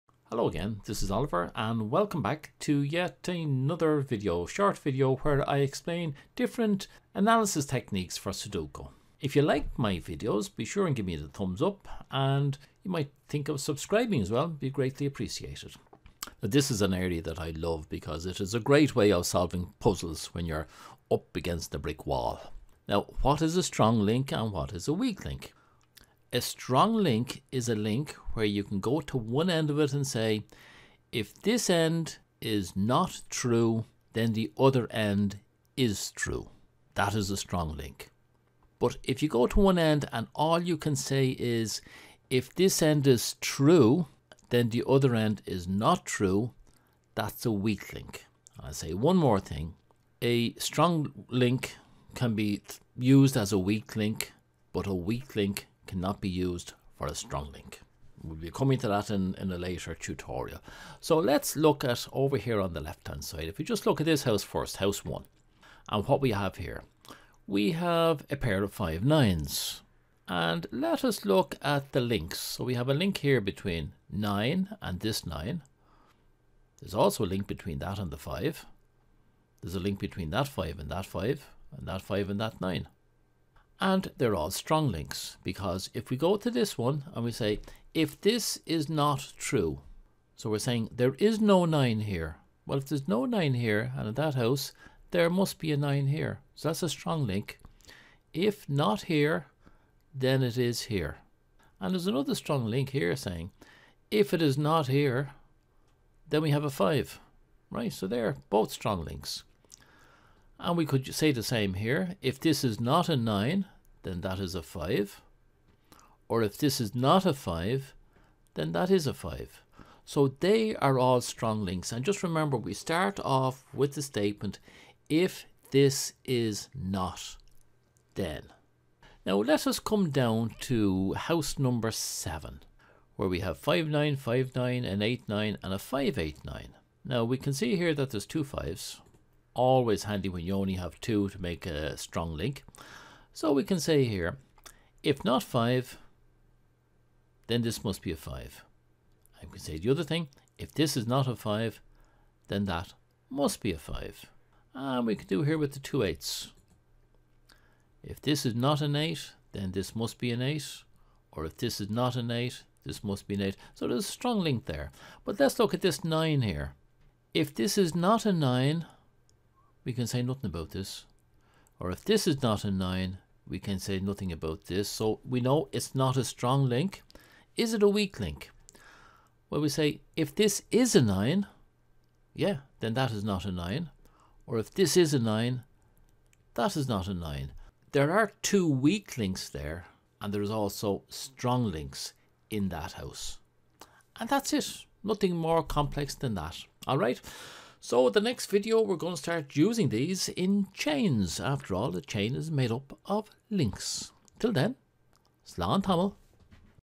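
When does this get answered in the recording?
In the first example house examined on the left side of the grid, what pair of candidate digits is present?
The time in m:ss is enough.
1:08.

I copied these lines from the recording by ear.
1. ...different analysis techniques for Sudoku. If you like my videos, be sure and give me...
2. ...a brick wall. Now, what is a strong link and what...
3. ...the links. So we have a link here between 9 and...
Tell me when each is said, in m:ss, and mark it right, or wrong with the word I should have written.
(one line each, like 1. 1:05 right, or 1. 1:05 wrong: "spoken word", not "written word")
1. 0:06 right
2. 0:21 right
3. 1:11 right.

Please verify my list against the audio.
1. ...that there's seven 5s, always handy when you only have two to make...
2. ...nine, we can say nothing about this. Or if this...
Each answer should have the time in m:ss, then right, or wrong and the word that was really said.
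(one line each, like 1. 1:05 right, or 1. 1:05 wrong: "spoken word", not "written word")
1. 2:17 wrong: "two", not "seven"
2. 2:48 right.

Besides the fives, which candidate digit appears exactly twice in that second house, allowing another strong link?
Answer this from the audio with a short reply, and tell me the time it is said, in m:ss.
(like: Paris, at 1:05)
8, at 2:35.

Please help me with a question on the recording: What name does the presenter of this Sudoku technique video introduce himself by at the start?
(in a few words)
Oliver.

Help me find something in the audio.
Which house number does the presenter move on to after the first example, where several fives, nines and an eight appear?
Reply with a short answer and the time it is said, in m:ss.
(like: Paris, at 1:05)
7, at 2:11.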